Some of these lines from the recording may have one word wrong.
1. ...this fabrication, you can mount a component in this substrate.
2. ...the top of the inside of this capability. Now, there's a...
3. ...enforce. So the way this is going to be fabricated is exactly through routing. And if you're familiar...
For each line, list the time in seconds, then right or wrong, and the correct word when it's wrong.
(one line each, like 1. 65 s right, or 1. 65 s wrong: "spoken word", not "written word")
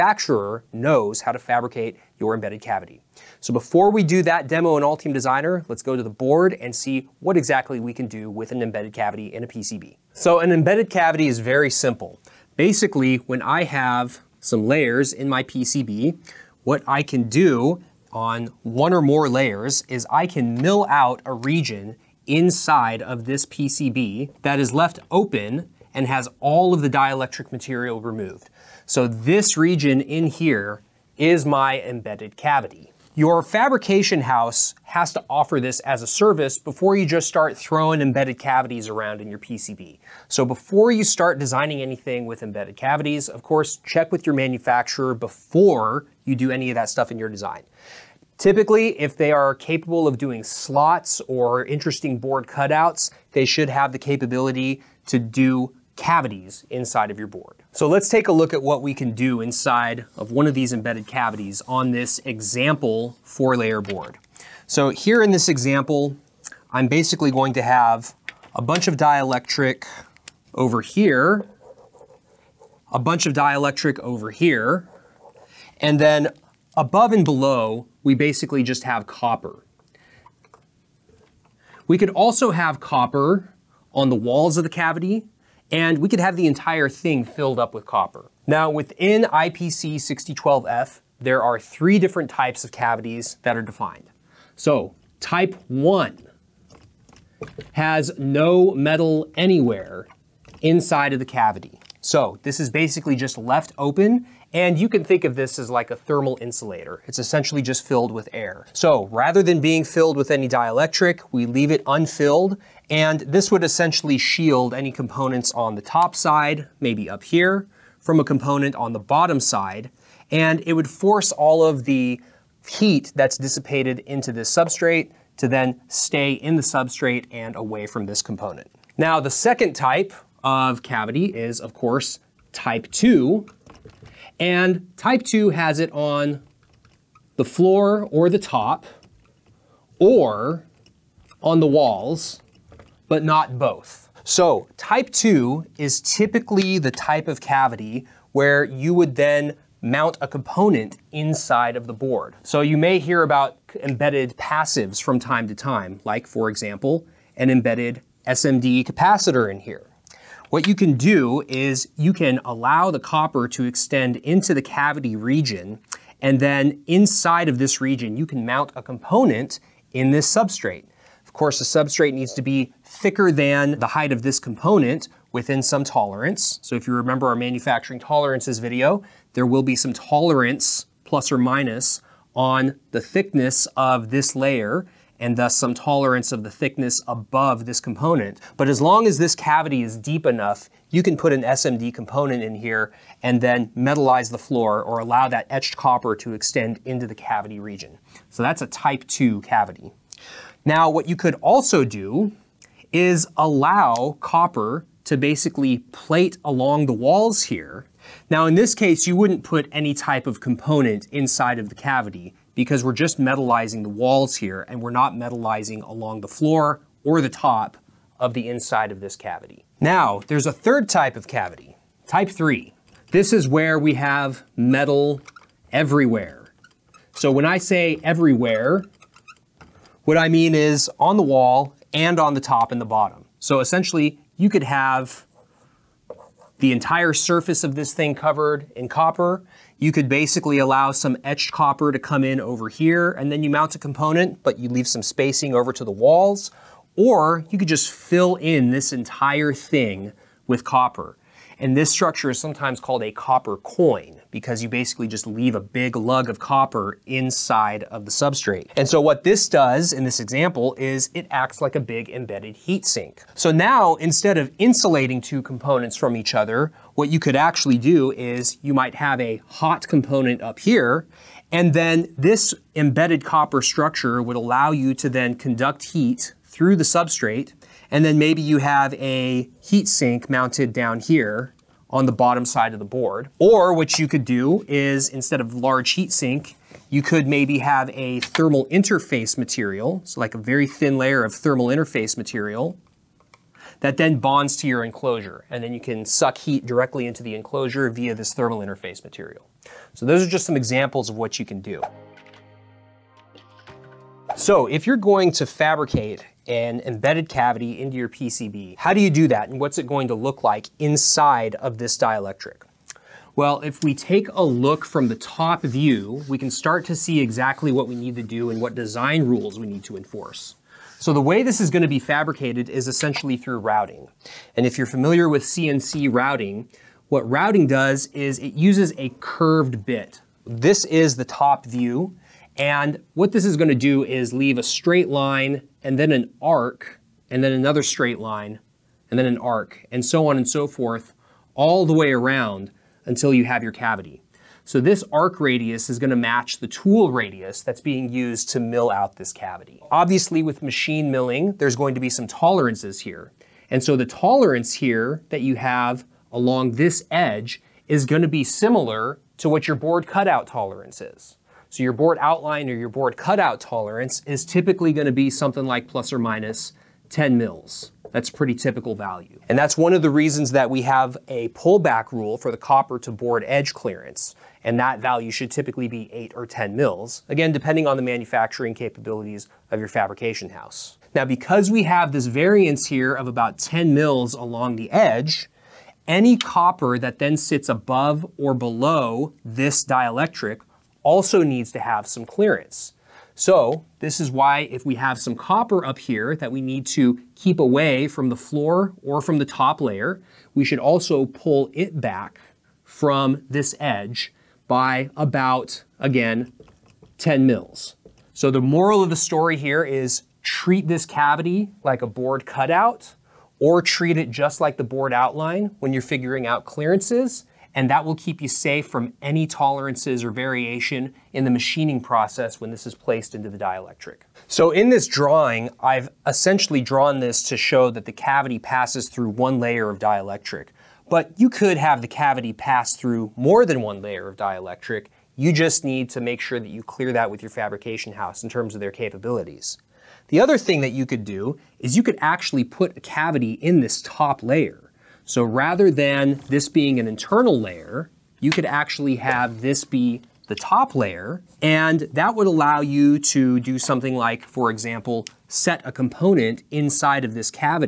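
1. 167 s wrong: "region", not "fabrication"
2. 217 s wrong: "cavity", not "capability"
3. 319 s wrong: "essentially", not "exactly".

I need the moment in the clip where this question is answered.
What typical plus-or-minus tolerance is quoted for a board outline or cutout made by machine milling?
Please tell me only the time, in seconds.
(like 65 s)
365 s.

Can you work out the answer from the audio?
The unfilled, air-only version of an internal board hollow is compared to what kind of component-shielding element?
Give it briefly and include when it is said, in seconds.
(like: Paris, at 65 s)
thermal insulator, at 105 s.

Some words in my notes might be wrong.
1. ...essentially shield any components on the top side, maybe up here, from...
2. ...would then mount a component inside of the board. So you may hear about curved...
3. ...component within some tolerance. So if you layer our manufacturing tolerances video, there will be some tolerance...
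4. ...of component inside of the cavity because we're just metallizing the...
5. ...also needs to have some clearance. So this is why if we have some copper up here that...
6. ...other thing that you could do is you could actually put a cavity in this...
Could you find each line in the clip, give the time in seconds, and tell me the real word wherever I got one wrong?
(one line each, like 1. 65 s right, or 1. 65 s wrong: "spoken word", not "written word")
1. 113 s right
2. 148 s wrong: "embedded", not "curved"
3. 174 s wrong: "remember", not "layer"
4. 210 s right
5. 391 s right
6. 440 s right.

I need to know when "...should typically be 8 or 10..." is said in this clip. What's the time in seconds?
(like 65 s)
375 s.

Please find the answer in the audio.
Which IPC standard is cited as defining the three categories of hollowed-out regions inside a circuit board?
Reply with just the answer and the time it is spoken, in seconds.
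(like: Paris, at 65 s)
IPC 6012F, at 89 s.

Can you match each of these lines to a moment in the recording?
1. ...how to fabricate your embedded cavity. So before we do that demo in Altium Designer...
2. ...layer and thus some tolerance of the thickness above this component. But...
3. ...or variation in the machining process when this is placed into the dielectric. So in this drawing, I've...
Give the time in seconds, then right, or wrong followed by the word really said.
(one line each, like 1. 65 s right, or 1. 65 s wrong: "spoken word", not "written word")
1. 1 s right
2. 184 s right
3. 420 s right.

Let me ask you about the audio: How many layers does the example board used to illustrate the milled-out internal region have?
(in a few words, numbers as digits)
4.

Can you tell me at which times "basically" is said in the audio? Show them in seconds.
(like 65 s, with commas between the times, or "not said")
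12 s, 66 s, 78 s, 102 s, 205 s, 240 s, 254 s.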